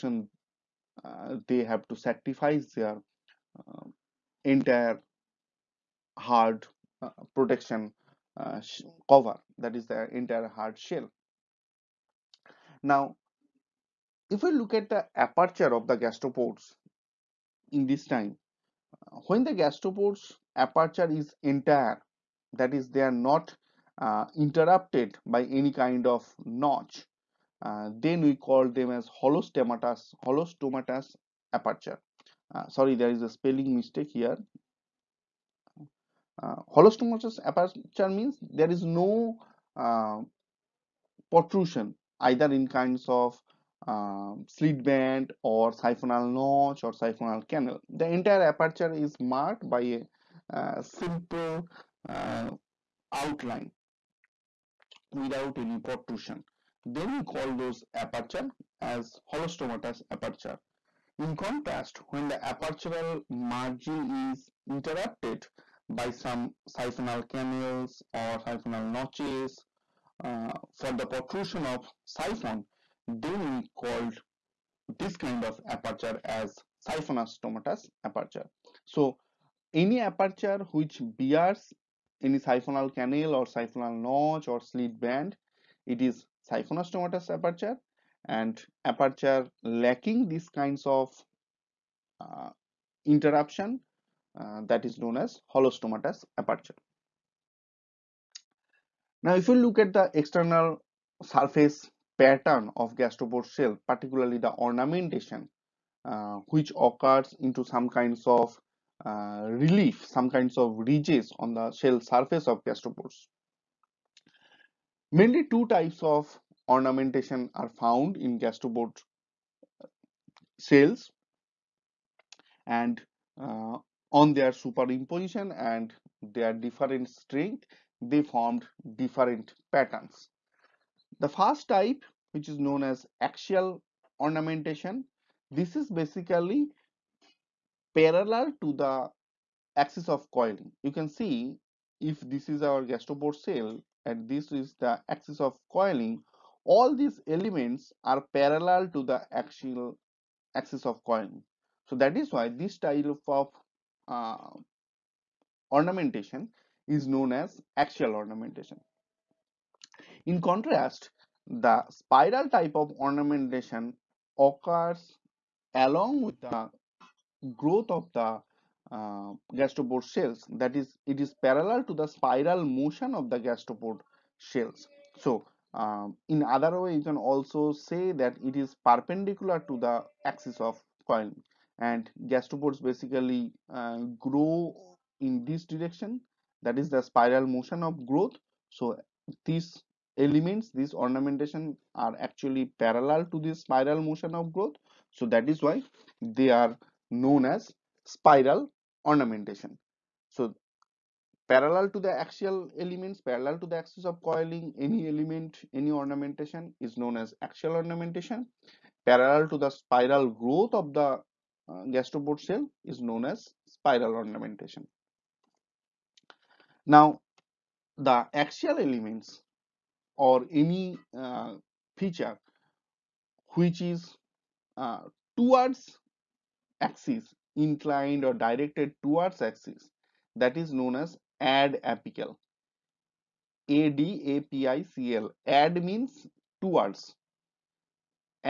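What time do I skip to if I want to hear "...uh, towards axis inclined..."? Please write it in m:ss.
3:44.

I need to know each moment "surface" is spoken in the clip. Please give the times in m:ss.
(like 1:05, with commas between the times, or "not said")
1:41, 1:52.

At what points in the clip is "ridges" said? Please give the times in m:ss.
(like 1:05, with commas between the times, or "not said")
1:50.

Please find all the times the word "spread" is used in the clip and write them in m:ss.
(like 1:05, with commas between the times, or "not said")
not said.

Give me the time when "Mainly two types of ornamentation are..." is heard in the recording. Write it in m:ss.
1:55.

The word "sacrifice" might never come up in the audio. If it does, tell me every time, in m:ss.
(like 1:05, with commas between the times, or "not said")
0:01.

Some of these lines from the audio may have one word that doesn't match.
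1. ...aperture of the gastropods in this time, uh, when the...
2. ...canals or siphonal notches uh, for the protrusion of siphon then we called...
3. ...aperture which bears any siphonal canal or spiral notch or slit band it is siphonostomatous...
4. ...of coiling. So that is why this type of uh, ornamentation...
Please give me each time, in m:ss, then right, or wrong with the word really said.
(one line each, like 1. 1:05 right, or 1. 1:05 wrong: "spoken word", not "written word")
1. 0:15 right
2. 1:07 right
3. 1:19 wrong: "siphonal", not "spiral"
4. 2:30 right.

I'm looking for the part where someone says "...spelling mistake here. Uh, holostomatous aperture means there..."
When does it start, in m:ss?
0:33.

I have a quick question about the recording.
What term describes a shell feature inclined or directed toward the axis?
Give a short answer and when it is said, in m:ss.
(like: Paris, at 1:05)
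ad apical, at 3:51.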